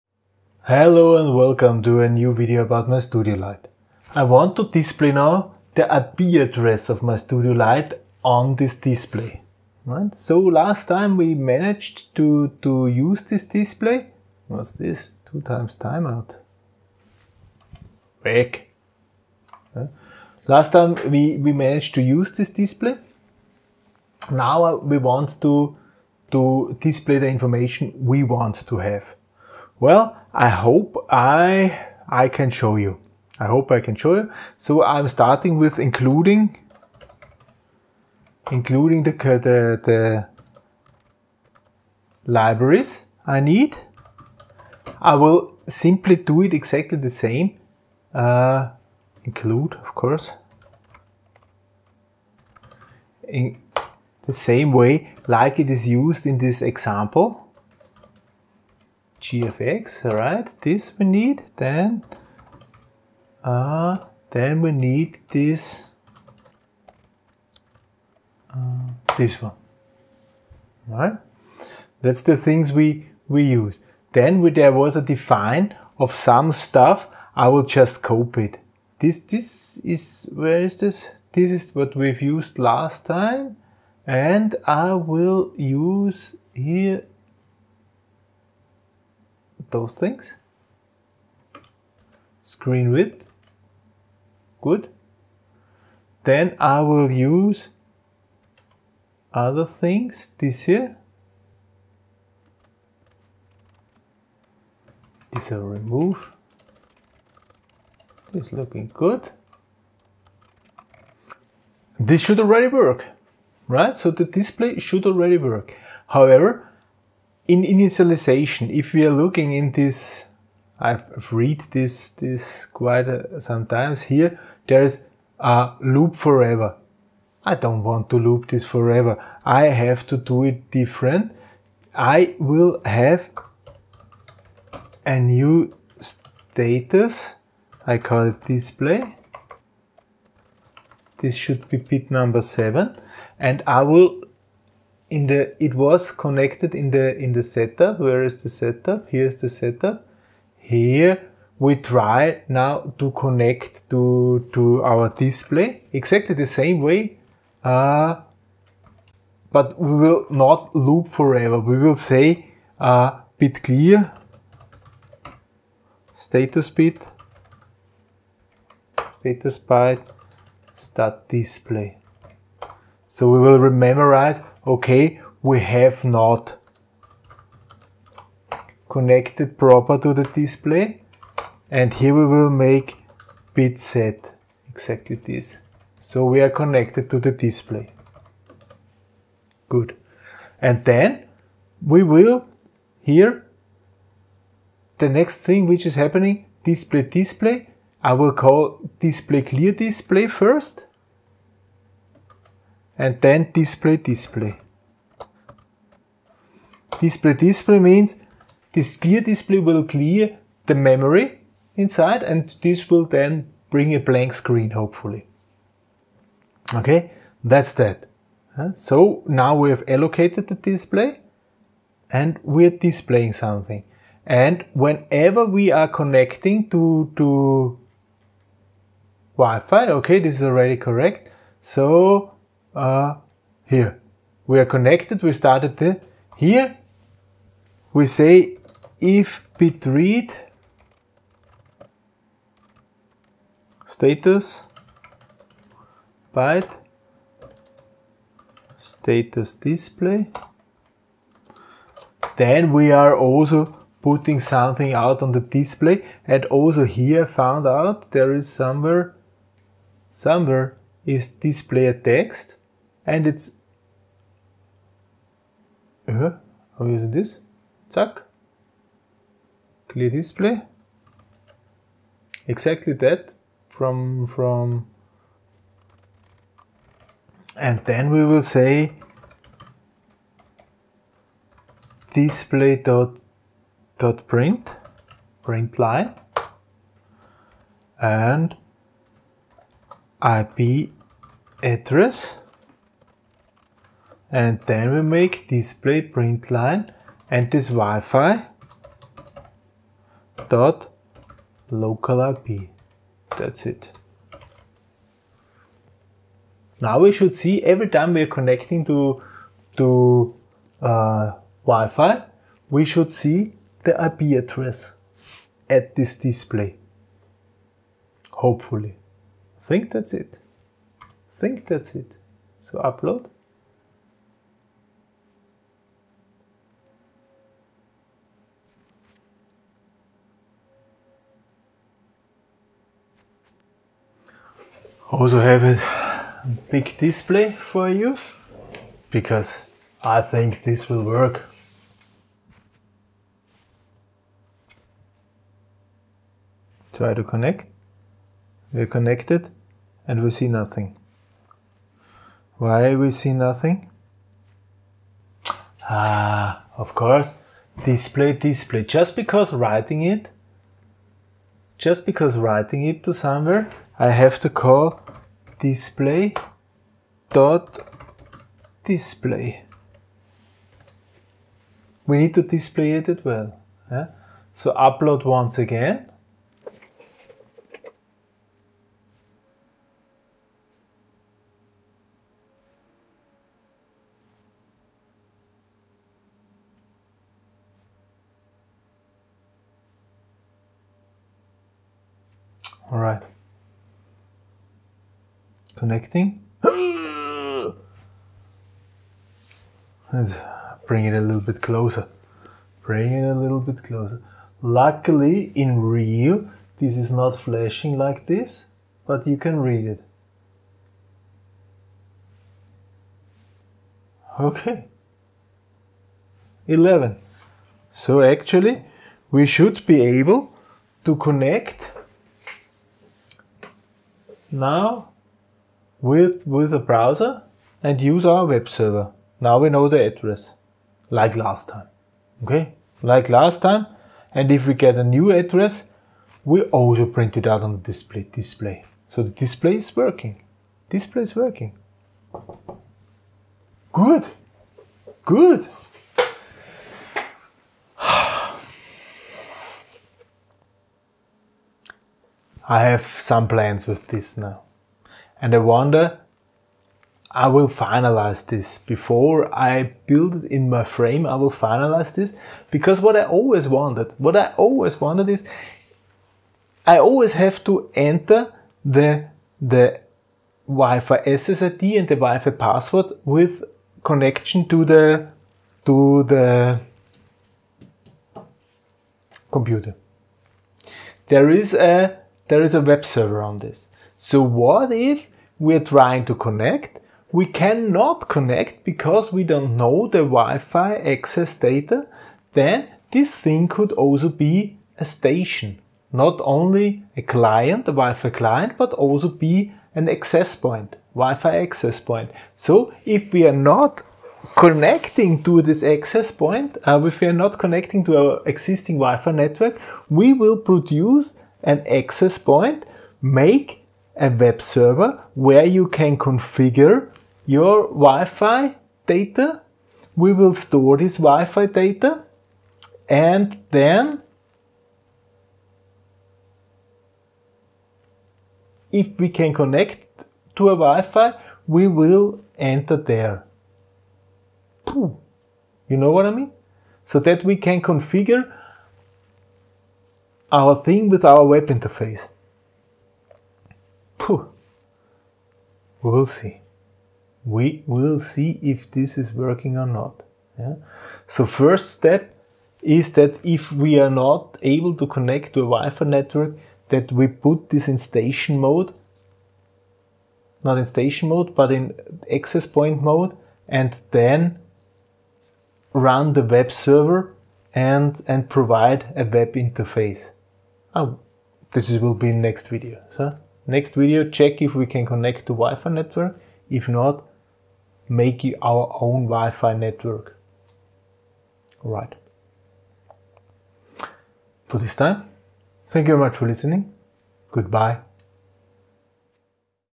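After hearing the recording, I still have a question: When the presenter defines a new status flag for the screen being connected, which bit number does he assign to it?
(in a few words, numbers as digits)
7.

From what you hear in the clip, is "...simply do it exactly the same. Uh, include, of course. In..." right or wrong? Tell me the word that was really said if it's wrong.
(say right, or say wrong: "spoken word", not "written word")
right.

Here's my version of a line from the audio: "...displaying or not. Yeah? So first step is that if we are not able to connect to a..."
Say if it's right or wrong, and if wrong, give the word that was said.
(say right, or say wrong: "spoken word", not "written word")
wrong: "working", not "displaying".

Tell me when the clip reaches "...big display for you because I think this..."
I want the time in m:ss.
5:36.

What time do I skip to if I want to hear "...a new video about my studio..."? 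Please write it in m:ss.
0:02.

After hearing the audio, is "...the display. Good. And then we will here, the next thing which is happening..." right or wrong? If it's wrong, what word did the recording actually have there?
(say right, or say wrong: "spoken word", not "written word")
right.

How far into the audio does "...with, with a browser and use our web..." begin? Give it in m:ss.
7:06.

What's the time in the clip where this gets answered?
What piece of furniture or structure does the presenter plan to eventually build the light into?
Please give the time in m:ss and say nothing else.
7:40.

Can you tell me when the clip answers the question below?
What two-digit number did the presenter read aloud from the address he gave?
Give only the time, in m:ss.
6:56.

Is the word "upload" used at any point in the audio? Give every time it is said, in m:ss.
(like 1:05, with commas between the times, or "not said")
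5:22, 6:14.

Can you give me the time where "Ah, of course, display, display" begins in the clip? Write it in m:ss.
5:55.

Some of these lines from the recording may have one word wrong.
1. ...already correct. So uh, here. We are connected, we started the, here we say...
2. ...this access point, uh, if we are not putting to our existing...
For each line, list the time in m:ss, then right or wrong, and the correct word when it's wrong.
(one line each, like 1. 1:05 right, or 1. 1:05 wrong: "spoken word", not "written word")
1. 3:50 right
2. 8:25 wrong: "connecting", not "putting".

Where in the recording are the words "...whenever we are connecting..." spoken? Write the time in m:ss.
3:44.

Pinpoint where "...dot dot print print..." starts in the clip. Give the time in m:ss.
4:42.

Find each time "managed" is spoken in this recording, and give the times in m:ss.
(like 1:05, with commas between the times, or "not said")
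0:11, 0:21.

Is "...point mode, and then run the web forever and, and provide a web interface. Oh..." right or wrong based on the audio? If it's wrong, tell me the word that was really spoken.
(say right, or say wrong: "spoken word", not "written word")
wrong: "server", not "forever".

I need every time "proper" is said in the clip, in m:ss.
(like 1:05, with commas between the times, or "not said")
2:59.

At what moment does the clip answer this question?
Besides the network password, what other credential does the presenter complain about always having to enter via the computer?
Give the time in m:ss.
7:50.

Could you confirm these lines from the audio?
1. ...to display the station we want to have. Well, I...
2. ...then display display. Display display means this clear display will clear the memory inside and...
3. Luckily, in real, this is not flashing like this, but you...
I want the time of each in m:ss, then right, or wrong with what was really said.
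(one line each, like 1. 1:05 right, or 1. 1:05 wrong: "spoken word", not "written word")
1. 0:26 wrong: "information", not "station"
2. 3:23 right
3. 6:44 right.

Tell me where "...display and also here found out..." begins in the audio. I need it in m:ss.
4:15.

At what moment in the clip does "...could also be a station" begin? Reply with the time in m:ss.
8:13.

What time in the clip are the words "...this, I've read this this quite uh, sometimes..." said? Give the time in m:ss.
1:59.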